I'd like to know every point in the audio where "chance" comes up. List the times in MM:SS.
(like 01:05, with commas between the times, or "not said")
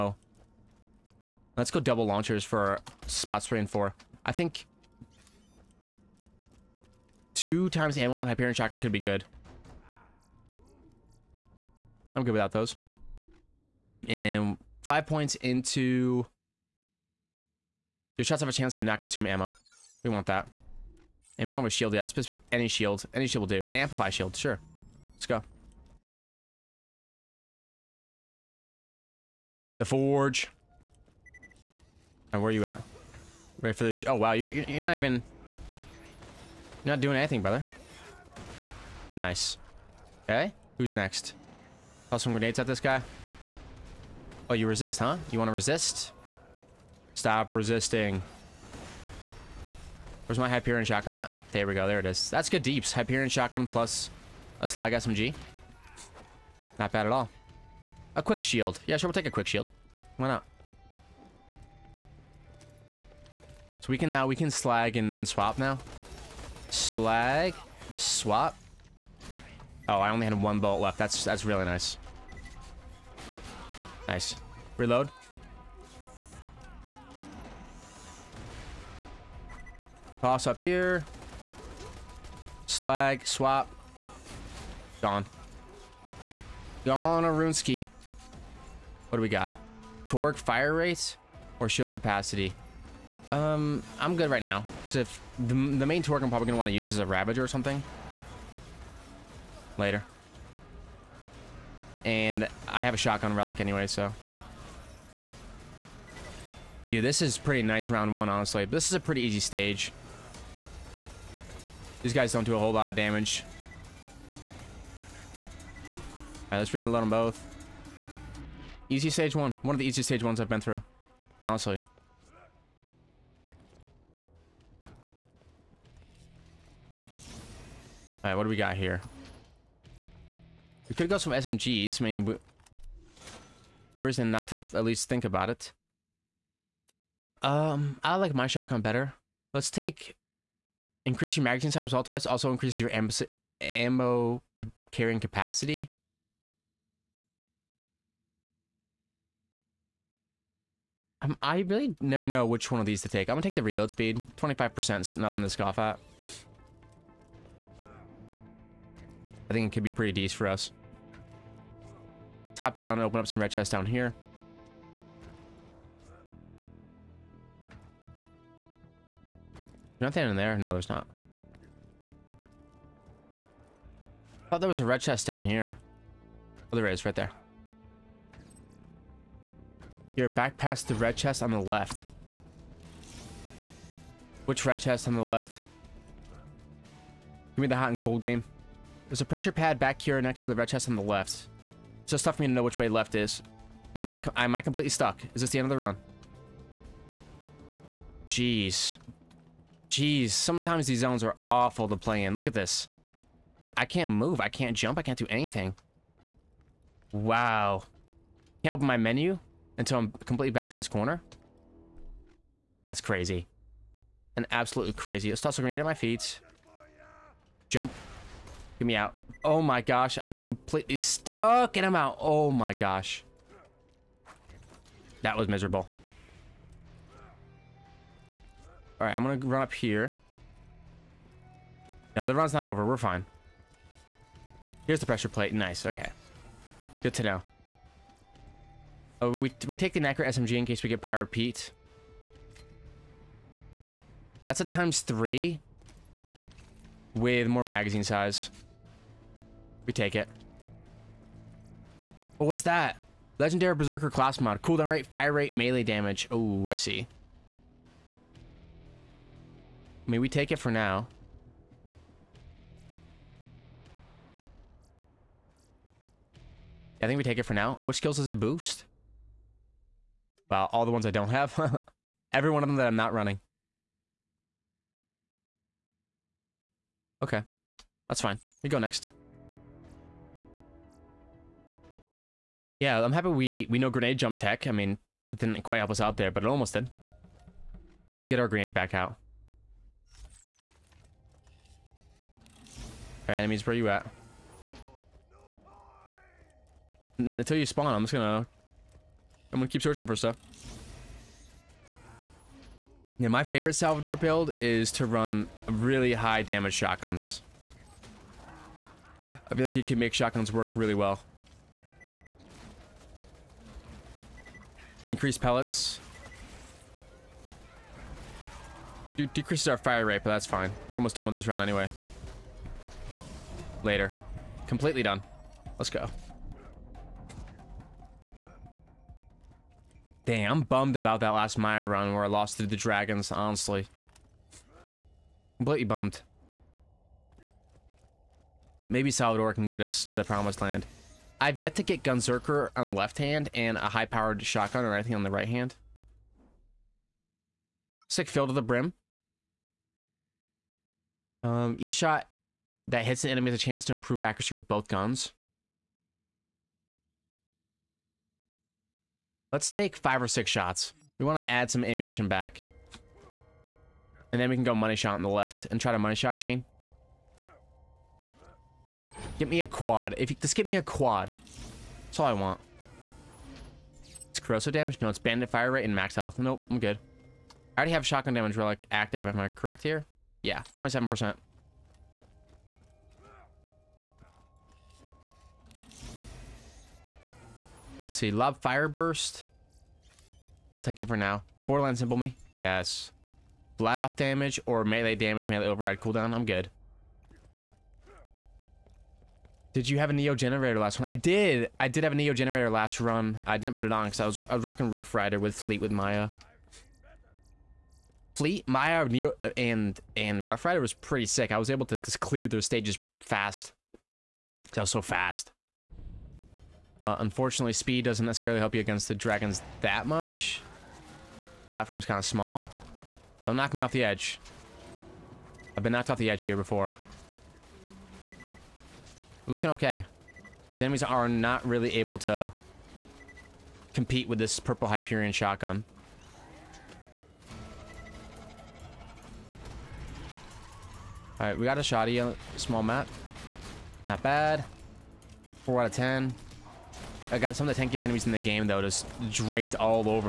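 00:18, 05:53.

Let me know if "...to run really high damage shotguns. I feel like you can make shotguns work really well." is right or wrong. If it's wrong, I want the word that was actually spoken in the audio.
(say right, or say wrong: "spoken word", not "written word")
right.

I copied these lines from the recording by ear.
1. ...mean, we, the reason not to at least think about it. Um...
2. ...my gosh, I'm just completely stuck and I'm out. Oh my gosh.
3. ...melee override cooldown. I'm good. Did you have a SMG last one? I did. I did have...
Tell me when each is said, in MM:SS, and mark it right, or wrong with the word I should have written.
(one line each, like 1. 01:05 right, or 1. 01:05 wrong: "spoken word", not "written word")
1. 02:12 right
2. 03:39 right
3. 06:35 wrong: "Neogenator", not "SMG".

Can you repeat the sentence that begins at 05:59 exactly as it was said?
Let's take five or six shots.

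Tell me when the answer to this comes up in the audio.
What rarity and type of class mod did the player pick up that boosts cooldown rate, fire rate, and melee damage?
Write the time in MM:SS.
04:13.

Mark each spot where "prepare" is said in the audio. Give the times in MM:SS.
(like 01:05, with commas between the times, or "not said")
not said.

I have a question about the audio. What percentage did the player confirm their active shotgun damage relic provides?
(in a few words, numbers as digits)
27%.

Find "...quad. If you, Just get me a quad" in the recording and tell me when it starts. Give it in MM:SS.
06:09.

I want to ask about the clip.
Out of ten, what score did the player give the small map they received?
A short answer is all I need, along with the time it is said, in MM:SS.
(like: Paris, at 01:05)
4, at 07:25.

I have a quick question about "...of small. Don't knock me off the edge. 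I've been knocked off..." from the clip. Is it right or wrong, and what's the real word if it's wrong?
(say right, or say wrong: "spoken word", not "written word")
right.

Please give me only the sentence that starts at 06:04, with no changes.
And then we can go money shot on the left and try to money shot chain.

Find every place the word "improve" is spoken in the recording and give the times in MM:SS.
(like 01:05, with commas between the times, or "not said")
05:53.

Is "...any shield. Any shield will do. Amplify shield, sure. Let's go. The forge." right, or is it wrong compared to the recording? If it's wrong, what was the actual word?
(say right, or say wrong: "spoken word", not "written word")
right.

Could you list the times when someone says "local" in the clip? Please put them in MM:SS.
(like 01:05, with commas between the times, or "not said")
not said.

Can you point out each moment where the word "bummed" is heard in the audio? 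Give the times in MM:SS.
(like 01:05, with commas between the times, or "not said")
05:30, 05:35.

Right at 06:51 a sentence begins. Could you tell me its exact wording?
I was able to just clear those stages fast.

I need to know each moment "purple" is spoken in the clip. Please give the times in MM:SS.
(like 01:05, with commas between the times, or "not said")
07:14.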